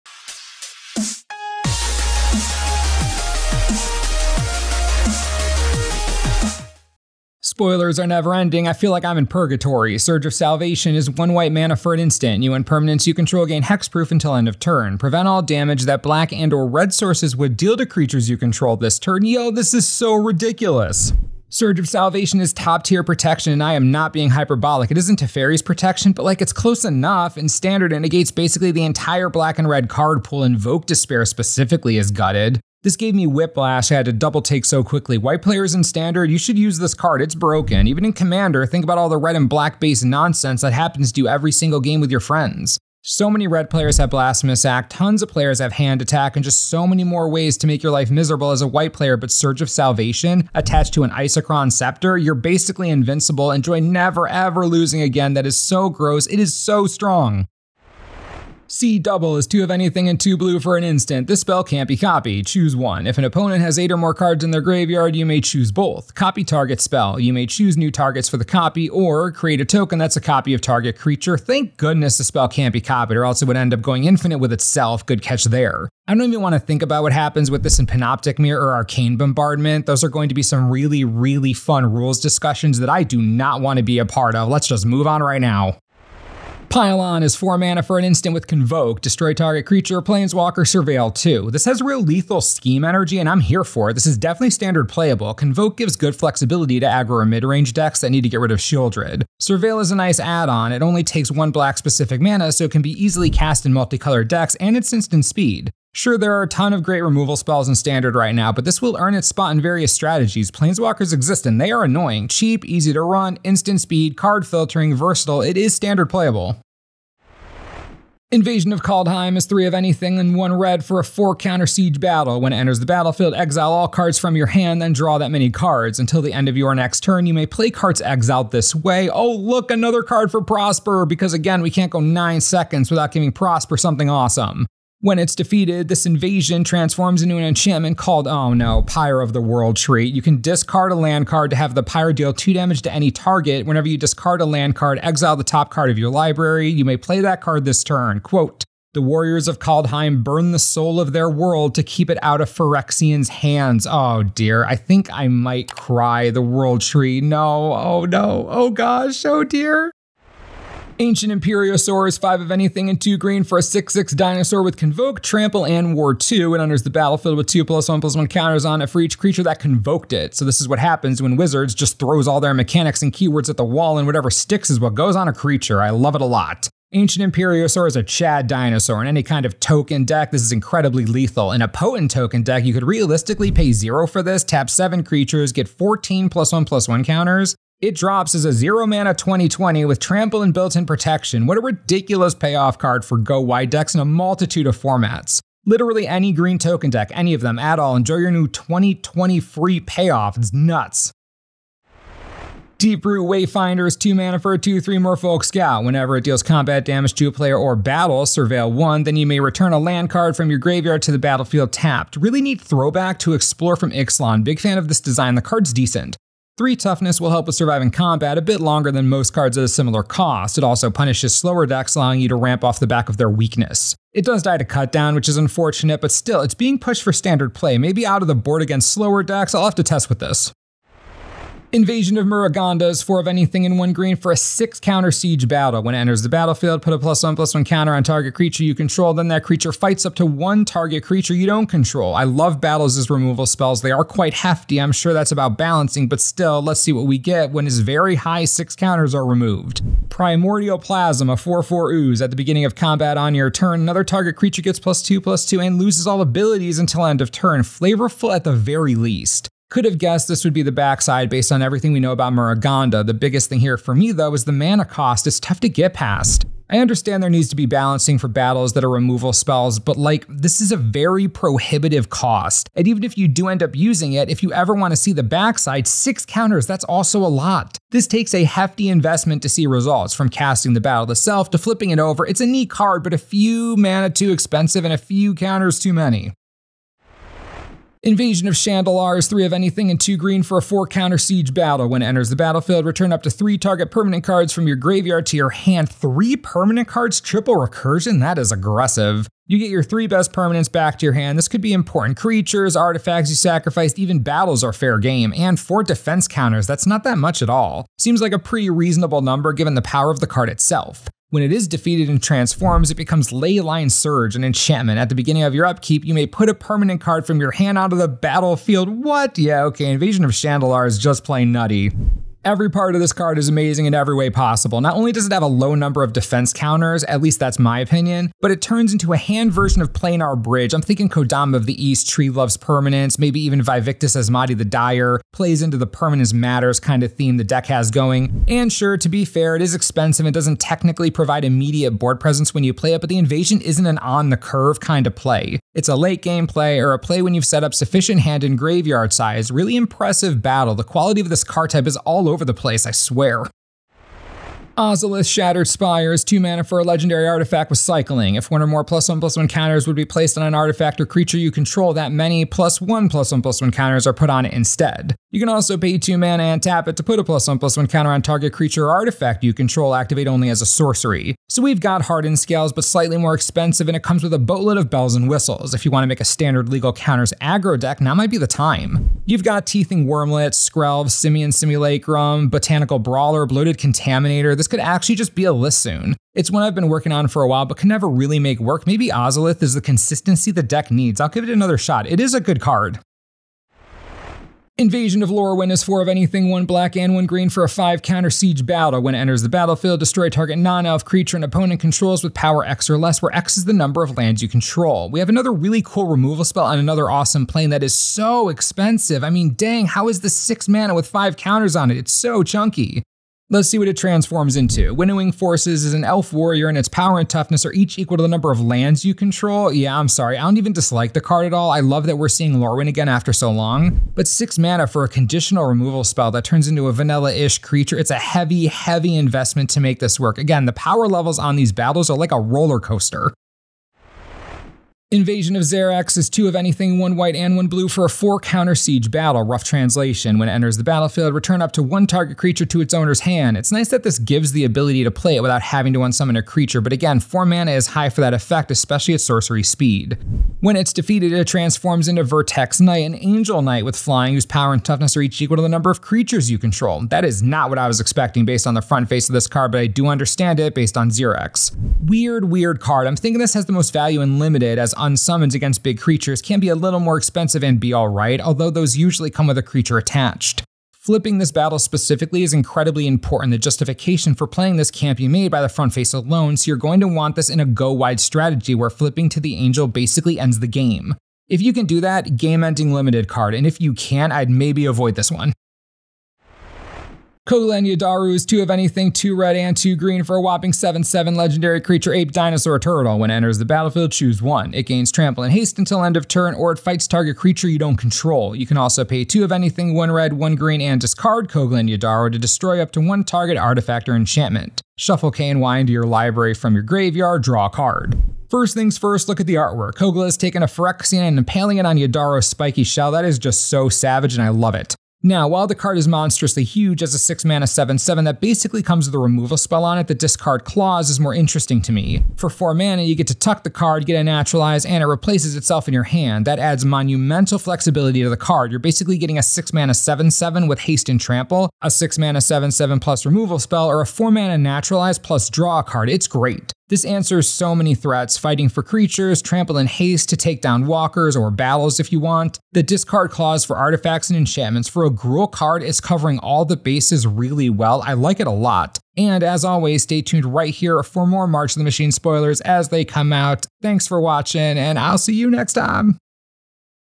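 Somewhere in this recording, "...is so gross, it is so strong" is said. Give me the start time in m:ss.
0:55.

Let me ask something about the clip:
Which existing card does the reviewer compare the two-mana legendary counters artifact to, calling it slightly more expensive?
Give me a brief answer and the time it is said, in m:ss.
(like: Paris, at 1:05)
Hardened Scales, at 6:12.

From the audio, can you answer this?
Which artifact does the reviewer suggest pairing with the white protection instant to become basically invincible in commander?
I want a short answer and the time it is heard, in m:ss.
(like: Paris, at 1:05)
Isochron Scepter, at 0:51.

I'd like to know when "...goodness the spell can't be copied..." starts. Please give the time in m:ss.
1:11.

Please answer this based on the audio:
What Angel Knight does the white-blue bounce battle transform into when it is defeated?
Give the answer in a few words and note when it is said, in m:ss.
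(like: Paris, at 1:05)
Vertex Knight, at 7:32.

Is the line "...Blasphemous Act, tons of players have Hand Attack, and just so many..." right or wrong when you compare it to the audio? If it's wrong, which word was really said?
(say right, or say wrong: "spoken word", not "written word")
right.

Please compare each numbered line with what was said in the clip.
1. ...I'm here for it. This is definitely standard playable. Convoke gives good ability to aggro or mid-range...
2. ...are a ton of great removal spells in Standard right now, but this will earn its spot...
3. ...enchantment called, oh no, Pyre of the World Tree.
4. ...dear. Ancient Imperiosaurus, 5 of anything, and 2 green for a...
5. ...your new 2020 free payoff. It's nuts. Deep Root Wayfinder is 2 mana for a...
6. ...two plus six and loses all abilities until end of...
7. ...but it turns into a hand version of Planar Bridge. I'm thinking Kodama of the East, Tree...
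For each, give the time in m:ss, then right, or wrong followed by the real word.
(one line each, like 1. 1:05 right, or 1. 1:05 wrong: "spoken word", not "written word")
1. 1:33 wrong: "flexibility", not "ability"
2. 1:46 right
3. 2:17 right
4. 2:39 right
5. 3:18 right
6. 4:15 wrong: "two", not "six"
7. 5:28 right.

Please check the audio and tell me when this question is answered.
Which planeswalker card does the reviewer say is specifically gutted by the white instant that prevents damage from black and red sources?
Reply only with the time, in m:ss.
0:30.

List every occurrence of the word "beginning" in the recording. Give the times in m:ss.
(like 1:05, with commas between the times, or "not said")
4:12, 5:15.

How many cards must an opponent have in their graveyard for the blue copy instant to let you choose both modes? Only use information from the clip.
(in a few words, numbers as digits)
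8.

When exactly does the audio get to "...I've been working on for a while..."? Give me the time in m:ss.
6:26.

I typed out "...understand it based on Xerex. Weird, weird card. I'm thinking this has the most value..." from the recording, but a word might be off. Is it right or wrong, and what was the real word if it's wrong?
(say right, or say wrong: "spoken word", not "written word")
right.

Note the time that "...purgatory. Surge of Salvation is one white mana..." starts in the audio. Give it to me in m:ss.
0:09.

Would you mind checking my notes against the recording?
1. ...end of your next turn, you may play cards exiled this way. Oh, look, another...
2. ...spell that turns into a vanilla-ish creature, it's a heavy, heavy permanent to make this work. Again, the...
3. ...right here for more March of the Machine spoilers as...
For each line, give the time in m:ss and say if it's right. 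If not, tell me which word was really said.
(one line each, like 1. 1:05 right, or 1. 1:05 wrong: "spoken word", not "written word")
1. 2:06 right
2. 7:06 wrong: "investment", not "permanent"
3. 9:10 right.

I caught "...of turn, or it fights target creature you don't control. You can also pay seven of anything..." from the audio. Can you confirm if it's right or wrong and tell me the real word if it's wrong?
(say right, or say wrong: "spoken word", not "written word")
wrong: "two", not "seven".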